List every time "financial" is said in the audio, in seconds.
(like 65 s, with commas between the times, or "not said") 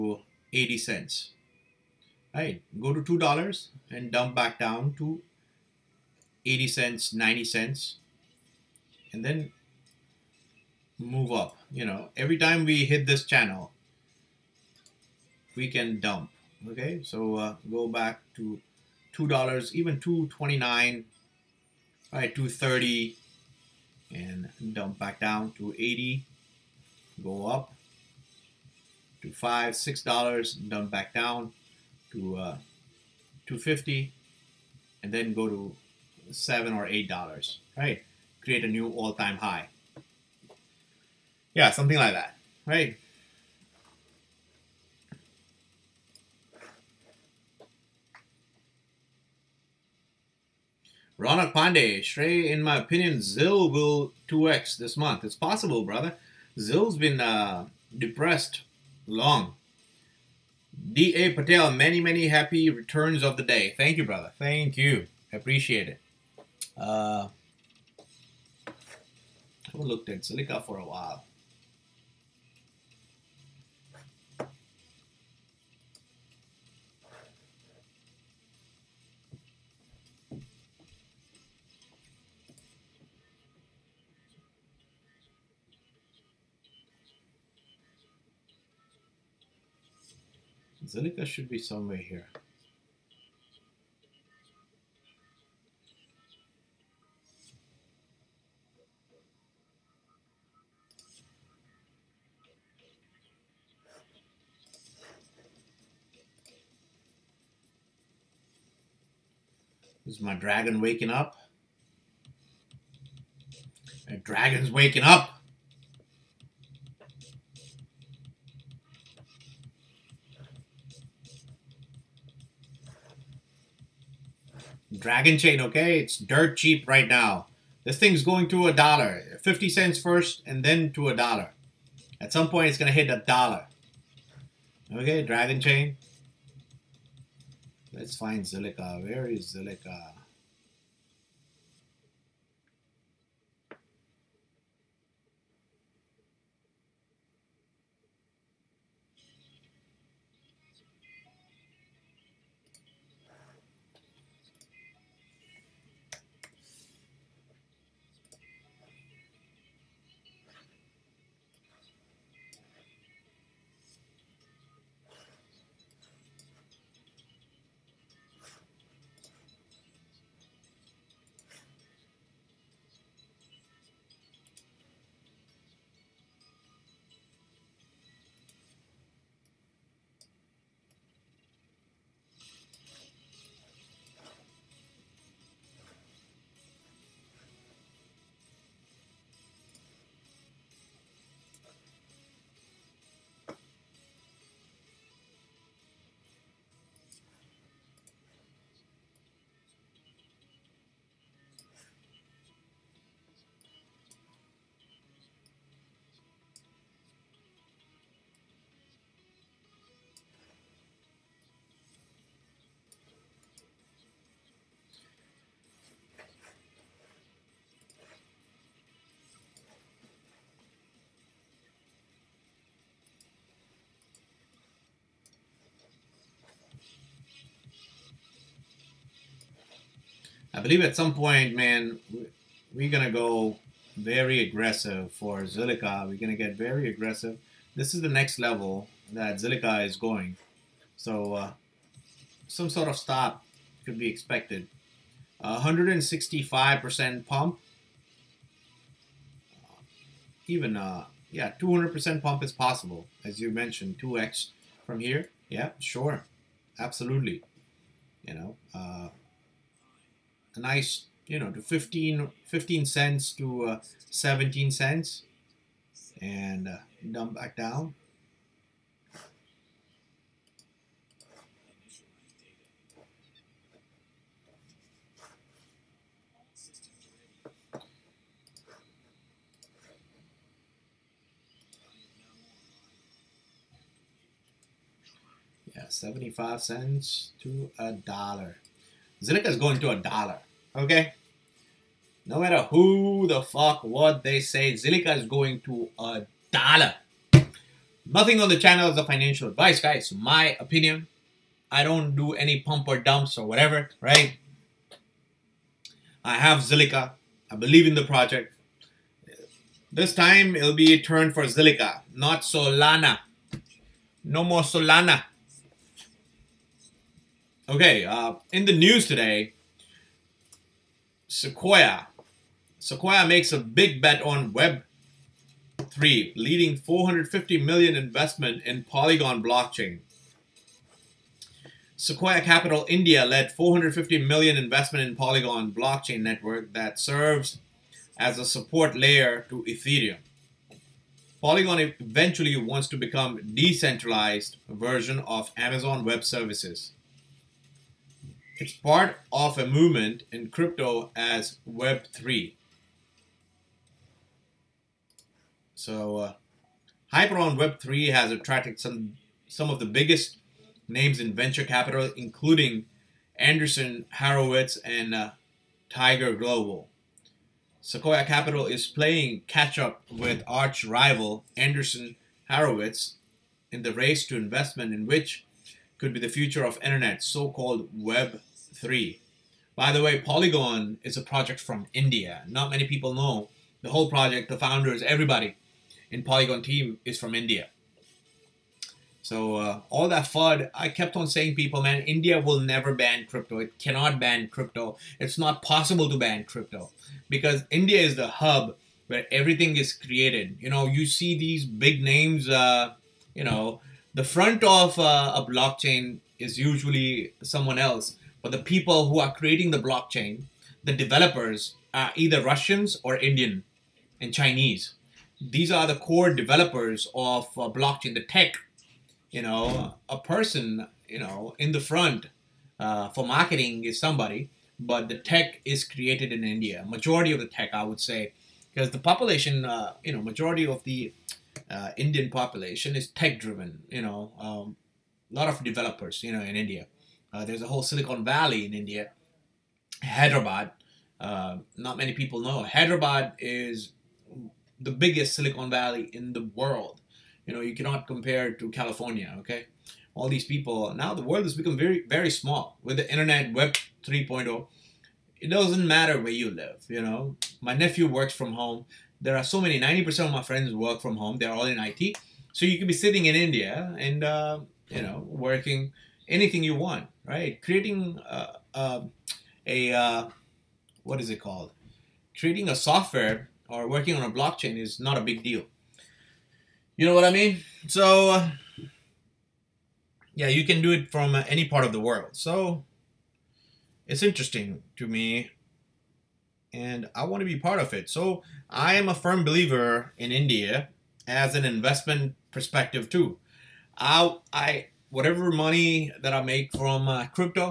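299 s.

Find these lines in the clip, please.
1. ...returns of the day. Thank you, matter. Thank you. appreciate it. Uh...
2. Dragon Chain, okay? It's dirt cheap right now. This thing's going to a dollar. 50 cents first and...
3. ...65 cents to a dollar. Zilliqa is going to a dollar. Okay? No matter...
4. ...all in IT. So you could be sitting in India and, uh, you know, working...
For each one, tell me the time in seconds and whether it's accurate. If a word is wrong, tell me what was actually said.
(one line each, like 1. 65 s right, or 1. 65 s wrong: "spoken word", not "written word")
1. 62 s wrong: "brother", not "matter"
2. 125 s right
3. 285 s wrong: "75", not "65"
4. 461 s right.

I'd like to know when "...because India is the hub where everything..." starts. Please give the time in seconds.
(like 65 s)
397 s.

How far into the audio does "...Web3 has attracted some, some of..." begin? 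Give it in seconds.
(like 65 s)
357 s.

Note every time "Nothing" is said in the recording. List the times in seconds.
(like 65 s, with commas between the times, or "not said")
298 s.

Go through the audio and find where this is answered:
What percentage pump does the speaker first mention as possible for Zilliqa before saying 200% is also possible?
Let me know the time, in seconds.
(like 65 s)
245 s.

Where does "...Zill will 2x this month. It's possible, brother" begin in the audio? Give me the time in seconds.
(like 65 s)
53 s.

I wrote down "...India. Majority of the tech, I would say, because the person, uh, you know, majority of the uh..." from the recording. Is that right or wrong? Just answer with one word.
wrong.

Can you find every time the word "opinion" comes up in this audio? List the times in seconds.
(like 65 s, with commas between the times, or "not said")
52 s, 300 s.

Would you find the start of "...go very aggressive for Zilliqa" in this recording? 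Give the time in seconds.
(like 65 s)
233 s.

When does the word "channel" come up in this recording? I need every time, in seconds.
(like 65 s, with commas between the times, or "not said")
13 s, 298 s.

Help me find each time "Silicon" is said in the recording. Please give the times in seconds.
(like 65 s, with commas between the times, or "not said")
437 s, 445 s.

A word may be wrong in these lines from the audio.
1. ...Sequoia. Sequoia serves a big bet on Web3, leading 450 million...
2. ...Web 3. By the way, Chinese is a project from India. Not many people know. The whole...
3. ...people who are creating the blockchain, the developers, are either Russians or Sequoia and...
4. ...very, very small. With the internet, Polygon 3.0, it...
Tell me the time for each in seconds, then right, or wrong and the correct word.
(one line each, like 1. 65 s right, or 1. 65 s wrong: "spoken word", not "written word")
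1. 321 s wrong: "makes", not "serves"
2. 377 s wrong: "Polygon", not "Chinese"
3. 408 s wrong: "Indian", not "Sequoia"
4. 451 s wrong: "Web", not "Polygon".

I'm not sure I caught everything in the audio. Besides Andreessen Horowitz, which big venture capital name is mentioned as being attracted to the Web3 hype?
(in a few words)
Tiger Global.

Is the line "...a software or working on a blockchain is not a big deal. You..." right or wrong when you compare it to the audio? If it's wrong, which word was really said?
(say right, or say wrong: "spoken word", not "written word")
right.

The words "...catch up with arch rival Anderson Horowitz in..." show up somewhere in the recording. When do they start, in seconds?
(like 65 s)
369 s.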